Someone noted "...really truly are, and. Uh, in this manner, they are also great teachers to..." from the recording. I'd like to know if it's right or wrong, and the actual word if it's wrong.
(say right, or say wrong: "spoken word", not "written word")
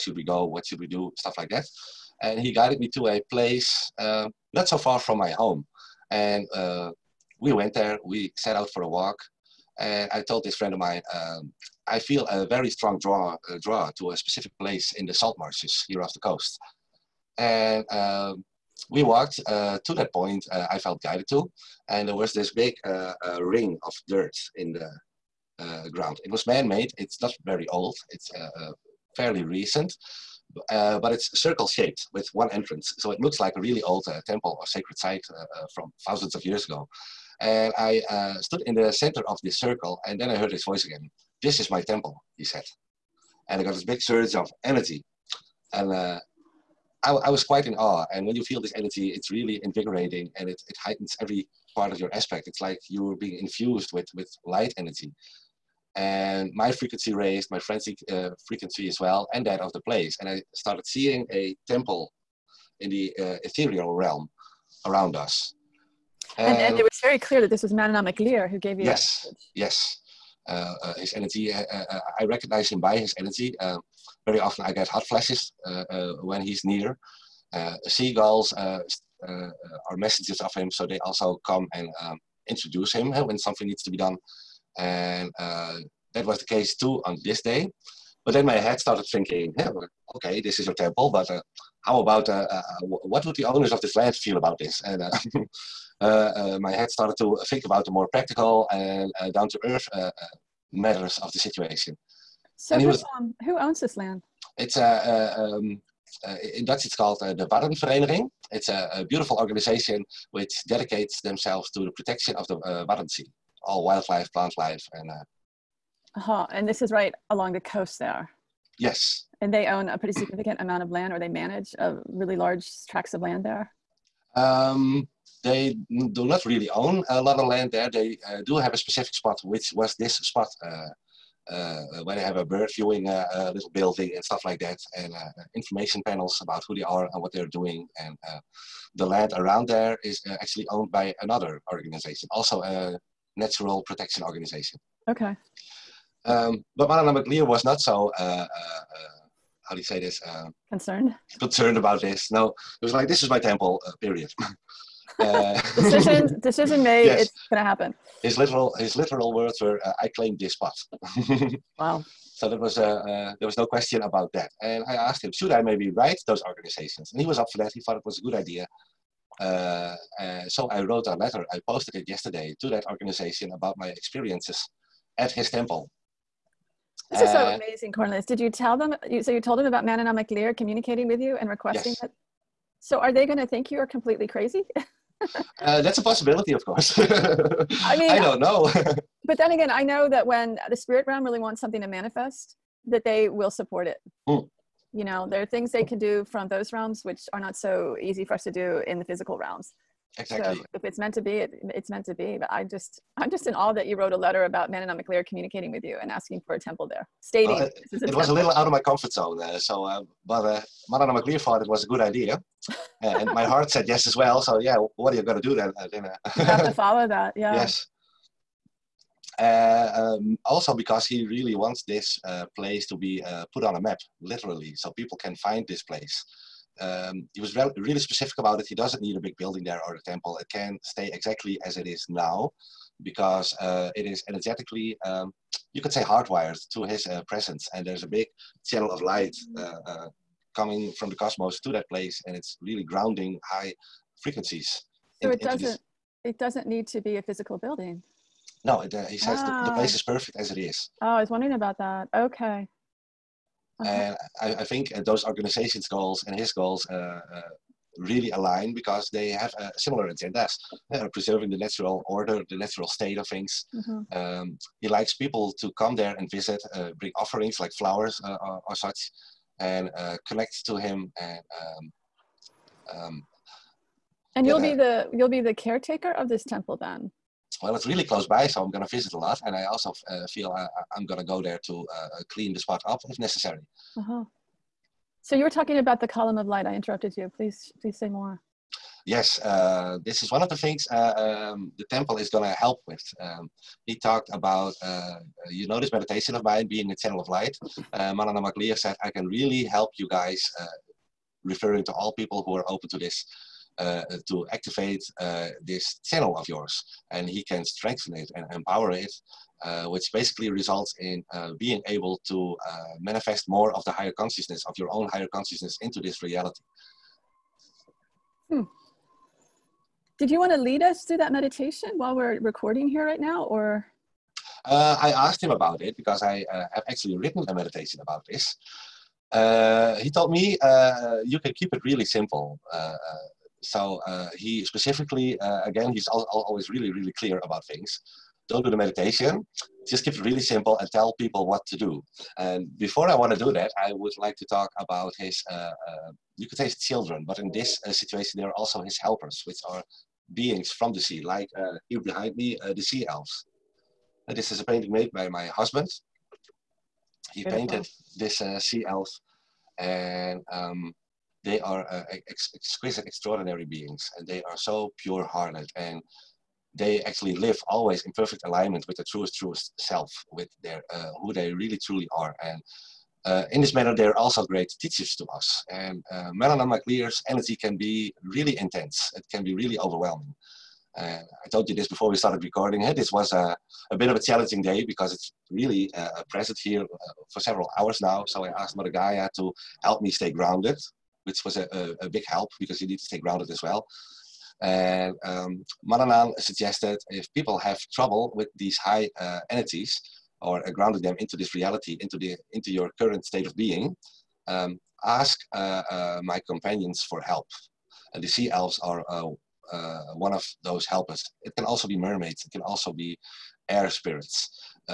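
right.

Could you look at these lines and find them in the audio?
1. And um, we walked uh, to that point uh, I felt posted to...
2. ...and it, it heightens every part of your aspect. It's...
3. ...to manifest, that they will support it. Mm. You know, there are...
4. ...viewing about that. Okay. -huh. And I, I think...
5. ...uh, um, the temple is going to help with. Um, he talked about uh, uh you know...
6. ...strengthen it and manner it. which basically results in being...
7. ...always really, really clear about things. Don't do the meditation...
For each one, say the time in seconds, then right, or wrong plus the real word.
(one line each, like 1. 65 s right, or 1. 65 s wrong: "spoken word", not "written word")
1. 17 s wrong: "guided", not "posted"
2. 50 s right
3. 191 s right
4. 251 s wrong: "wondering", not "viewing"
5. 290 s right
6. 307 s wrong: "empower", not "manner"
7. 336 s right.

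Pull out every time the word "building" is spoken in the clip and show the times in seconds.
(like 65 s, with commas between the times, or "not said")
133 s, 229 s, 247 s.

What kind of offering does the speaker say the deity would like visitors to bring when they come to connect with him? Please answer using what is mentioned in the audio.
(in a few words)
Flowers.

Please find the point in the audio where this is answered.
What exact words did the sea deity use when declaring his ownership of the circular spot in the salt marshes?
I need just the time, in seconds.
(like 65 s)
160 s.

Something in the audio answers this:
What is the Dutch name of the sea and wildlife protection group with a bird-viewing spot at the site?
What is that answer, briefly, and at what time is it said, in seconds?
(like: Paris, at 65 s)
Waddenvereniging, at 107 s.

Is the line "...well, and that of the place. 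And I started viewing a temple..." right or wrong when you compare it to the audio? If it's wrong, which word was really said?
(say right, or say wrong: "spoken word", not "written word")
wrong: "seeing", not "viewing".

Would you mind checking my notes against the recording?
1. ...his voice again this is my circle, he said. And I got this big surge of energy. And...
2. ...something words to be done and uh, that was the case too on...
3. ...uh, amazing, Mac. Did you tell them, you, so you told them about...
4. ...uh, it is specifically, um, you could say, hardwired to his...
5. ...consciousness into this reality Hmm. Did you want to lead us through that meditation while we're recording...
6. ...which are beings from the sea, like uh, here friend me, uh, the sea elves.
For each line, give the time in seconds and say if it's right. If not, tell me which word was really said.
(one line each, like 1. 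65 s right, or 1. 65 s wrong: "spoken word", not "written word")
1. 40 s wrong: "temple", not "circle"
2. 83 s wrong: "needs", not "words"
3. 177 s wrong: "Cornelis", not "Mac"
4. 233 s wrong: "energetically", not "specifically"
5. 315 s right
6. 349 s wrong: "behind", not "friend".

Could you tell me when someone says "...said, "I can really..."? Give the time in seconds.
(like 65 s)
298 s.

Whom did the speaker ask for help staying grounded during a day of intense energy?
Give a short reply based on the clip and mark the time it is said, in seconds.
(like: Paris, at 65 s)
Mother Gaia, at 388 s.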